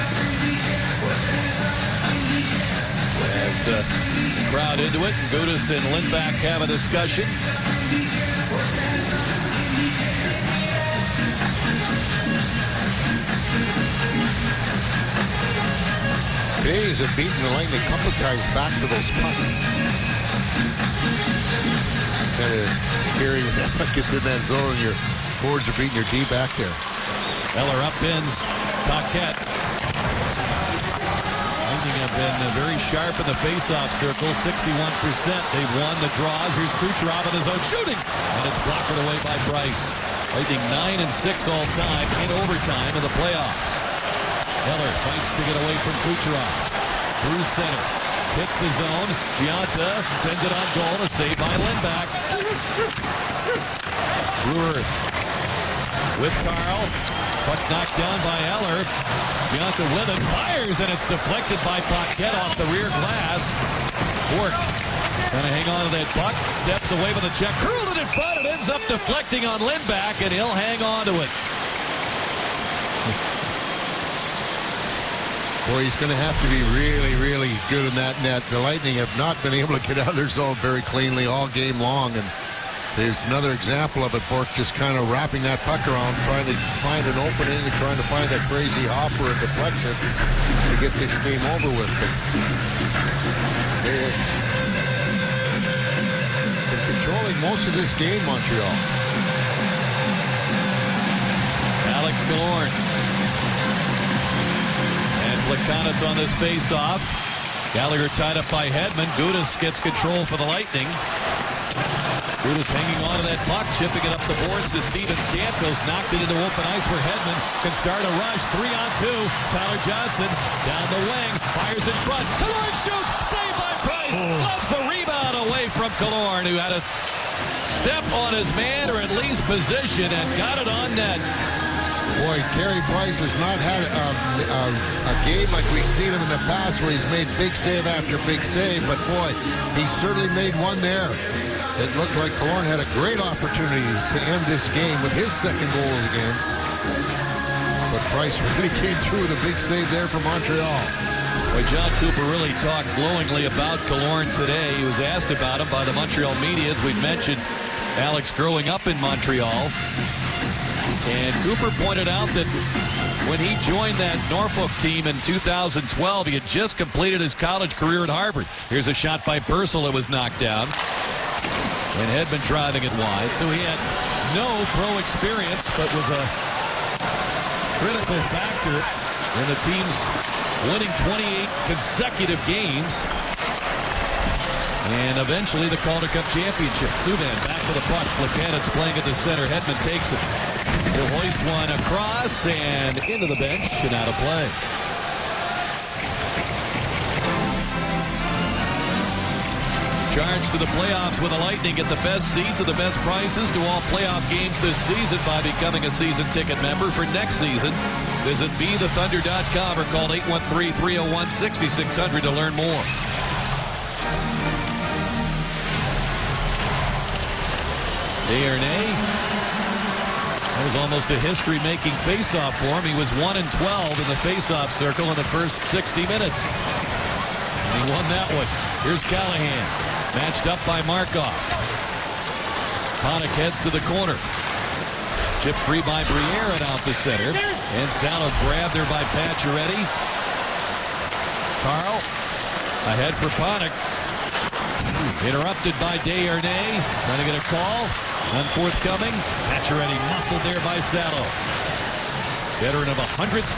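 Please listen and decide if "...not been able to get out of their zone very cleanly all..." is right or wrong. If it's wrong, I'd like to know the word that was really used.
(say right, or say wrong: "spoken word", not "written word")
right.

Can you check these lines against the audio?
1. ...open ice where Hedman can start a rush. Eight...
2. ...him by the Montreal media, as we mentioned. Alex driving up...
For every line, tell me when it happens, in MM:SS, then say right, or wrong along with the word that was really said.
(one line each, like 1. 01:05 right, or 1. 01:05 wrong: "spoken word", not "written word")
1. 01:56 wrong: "Three", not "Eight"
2. 02:35 wrong: "growing", not "driving".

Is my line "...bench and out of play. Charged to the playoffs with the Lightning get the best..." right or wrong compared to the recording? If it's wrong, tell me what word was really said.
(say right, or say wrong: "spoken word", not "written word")
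right.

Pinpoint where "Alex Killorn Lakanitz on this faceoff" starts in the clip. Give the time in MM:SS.
01:42.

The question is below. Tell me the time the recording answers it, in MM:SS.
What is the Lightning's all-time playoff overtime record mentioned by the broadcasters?
00:41.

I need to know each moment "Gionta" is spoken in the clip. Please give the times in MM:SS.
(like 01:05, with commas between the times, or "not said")
00:49, 00:59.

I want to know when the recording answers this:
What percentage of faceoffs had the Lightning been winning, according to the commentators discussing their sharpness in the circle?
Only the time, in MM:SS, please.
00:34.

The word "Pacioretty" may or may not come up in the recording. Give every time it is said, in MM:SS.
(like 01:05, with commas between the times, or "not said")
03:59, 04:09.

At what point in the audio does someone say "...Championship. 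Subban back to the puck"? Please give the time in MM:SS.
03:06.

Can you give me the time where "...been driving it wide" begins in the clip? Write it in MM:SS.
02:52.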